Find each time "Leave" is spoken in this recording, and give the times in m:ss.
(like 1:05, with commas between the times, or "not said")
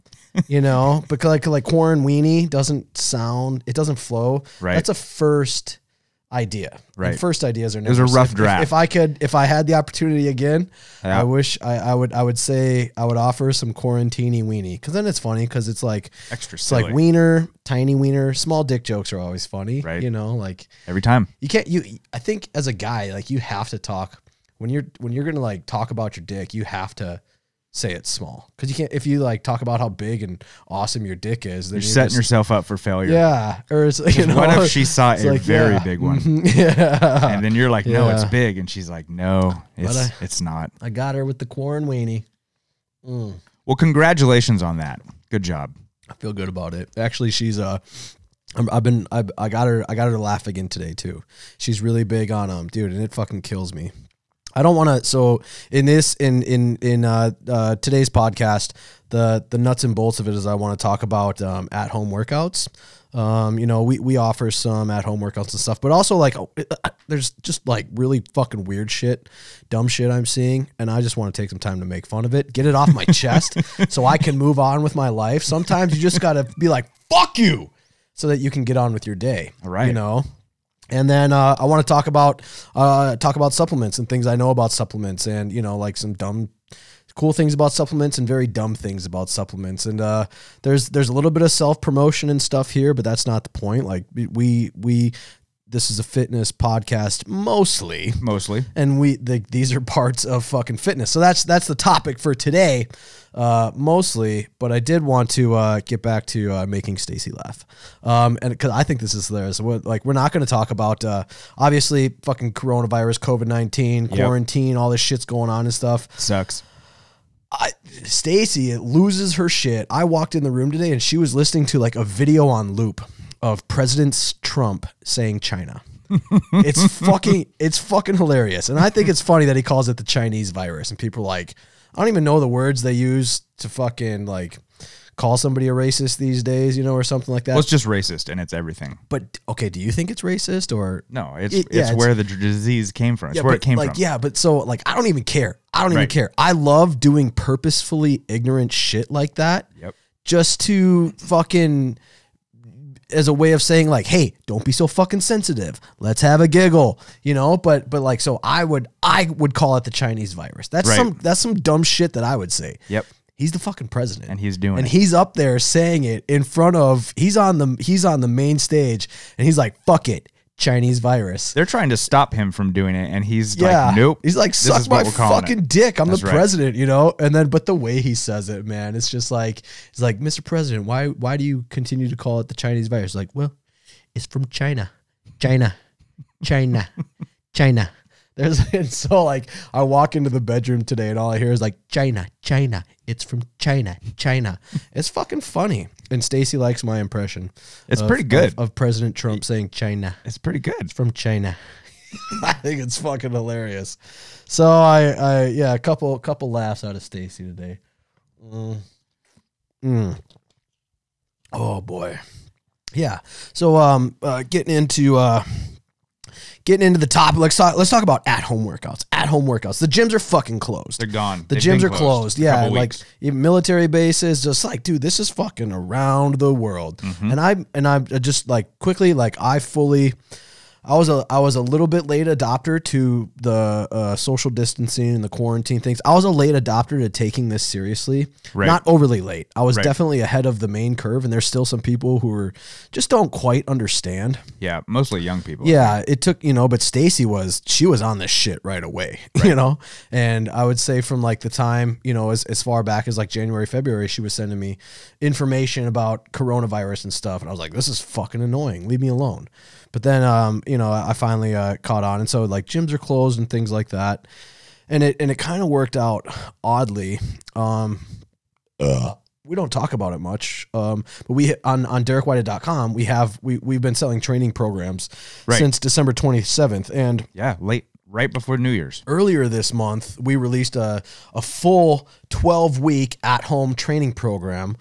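4:18.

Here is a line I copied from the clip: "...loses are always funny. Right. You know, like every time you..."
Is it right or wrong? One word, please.
wrong.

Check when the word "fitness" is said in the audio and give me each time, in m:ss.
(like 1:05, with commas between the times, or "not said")
1:36, 1:40.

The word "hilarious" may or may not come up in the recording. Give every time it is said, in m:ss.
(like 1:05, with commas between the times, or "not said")
1:49, 2:08, 3:23.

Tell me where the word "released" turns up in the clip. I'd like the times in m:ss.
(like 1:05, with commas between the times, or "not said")
4:40.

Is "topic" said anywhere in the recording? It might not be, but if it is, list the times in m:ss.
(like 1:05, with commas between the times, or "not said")
1:41, 3:37.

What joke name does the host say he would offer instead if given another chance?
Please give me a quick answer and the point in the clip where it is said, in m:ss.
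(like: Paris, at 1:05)
quarantini weenie, at 0:13.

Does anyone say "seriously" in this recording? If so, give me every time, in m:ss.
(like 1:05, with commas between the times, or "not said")
3:57.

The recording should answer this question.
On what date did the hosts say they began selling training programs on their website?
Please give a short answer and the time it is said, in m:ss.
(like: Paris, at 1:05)
December 27th, at 4:35.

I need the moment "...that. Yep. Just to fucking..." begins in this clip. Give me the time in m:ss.
2:29.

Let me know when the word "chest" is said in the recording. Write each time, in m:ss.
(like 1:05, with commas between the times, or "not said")
1:13.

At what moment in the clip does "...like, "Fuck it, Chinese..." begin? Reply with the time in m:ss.
2:49.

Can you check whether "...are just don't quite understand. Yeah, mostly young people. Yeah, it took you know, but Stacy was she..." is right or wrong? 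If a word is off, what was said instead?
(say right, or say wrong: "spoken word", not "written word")
right.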